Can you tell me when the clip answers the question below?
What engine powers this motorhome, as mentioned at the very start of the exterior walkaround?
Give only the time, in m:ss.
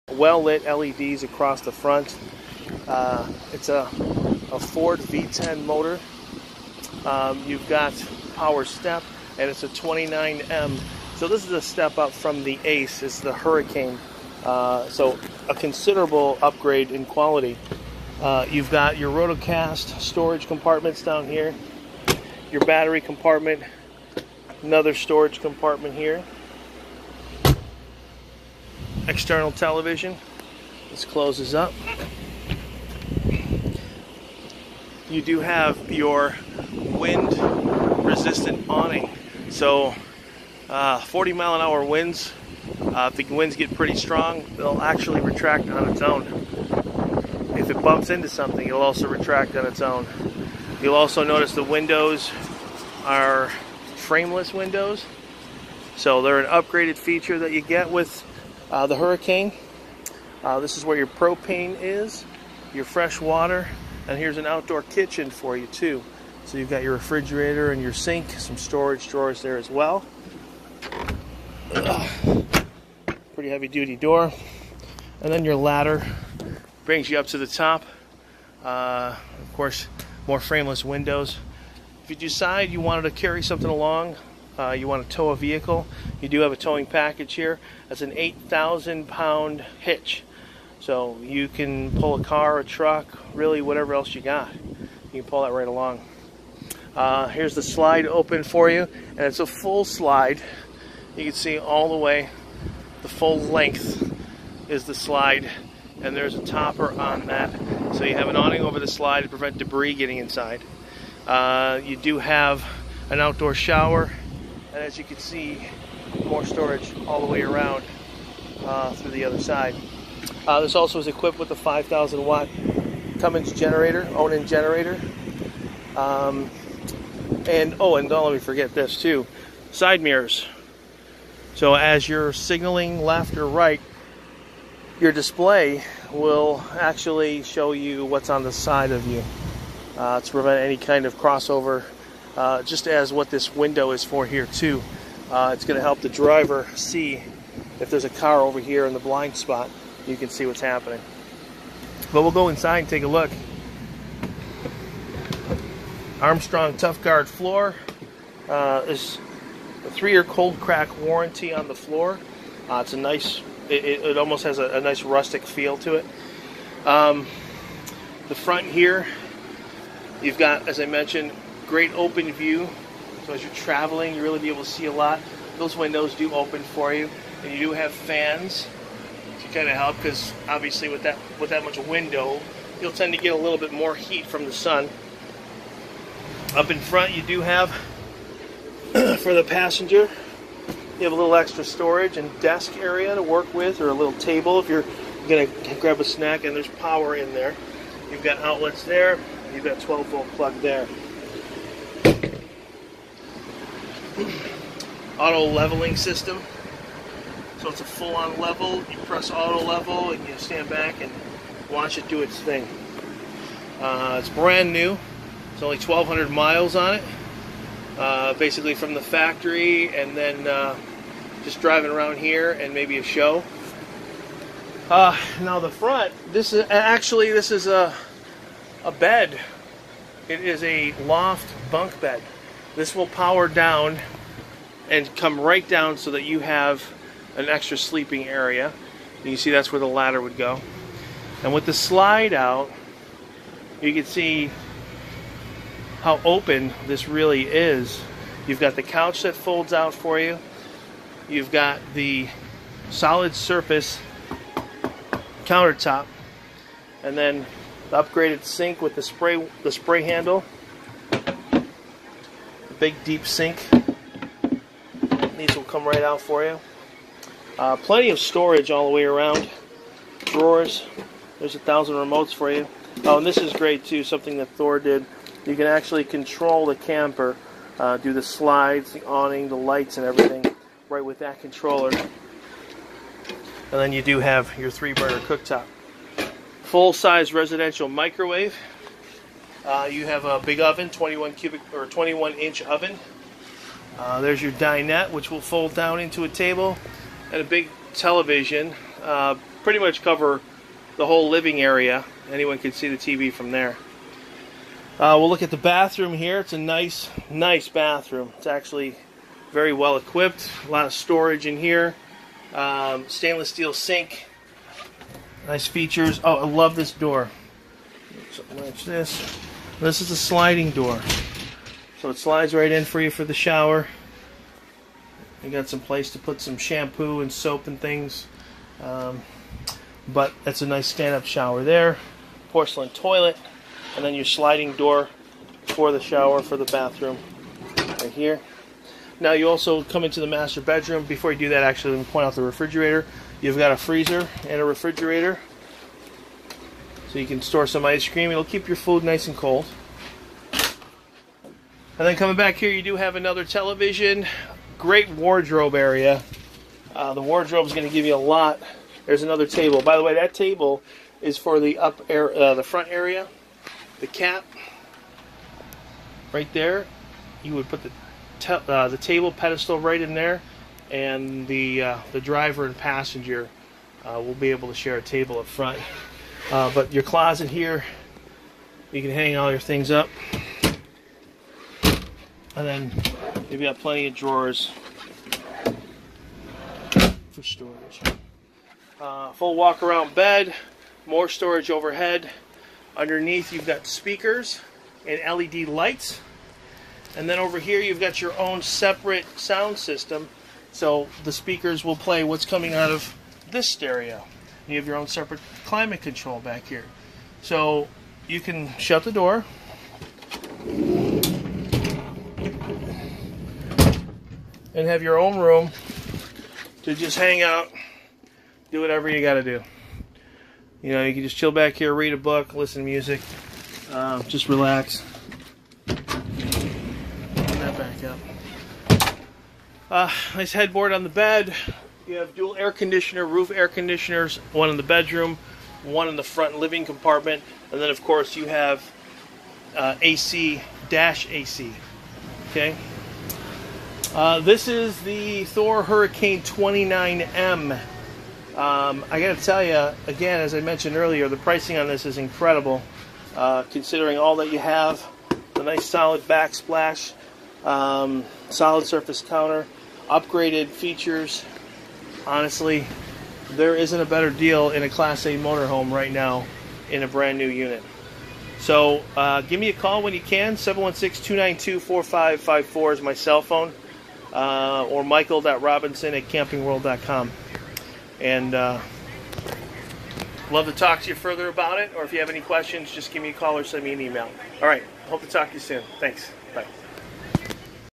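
0:04.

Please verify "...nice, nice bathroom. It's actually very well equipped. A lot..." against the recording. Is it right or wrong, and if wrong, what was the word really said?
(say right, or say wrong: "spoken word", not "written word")
right.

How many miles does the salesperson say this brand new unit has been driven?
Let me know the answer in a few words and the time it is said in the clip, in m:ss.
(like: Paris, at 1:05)
1,200, at 3:35.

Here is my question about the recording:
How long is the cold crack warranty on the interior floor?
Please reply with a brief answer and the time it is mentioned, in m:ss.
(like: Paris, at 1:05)
3 years, at 2:39.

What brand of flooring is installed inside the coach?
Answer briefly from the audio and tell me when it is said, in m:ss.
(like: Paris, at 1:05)
Armstrong Tough Guard, at 2:36.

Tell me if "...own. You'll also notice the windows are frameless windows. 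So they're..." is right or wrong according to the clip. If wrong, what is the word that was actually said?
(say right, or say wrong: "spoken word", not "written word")
right.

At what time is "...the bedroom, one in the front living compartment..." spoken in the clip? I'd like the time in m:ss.
7:14.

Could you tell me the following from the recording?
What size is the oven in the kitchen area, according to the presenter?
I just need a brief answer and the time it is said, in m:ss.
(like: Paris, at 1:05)
21 inch, at 4:51.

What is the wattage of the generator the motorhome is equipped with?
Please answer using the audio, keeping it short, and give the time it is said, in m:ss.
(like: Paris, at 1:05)
5,000 watts, at 2:01.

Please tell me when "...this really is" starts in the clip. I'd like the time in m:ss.
4:06.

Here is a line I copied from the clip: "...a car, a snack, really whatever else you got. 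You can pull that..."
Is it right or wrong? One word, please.
wrong.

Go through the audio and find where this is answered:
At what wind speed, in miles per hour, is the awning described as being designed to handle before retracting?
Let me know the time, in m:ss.
0:41.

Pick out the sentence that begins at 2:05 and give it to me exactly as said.
Um, and oh, and don't let me forget this too side mirrors.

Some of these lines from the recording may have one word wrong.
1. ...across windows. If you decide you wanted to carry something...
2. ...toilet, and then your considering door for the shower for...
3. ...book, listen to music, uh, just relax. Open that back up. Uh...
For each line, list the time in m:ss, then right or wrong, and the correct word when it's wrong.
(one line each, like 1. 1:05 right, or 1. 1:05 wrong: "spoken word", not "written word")
1. 1:20 wrong: "frameless", not "across"
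2. 5:32 wrong: "sliding", not "considering"
3. 7:02 right.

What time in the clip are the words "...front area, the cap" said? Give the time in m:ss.
6:02.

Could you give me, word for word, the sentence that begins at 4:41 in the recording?
And then you do have your three burner cooktop.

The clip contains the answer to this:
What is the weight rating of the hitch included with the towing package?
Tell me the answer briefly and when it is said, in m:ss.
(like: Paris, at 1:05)
8,000 pounds, at 1:28.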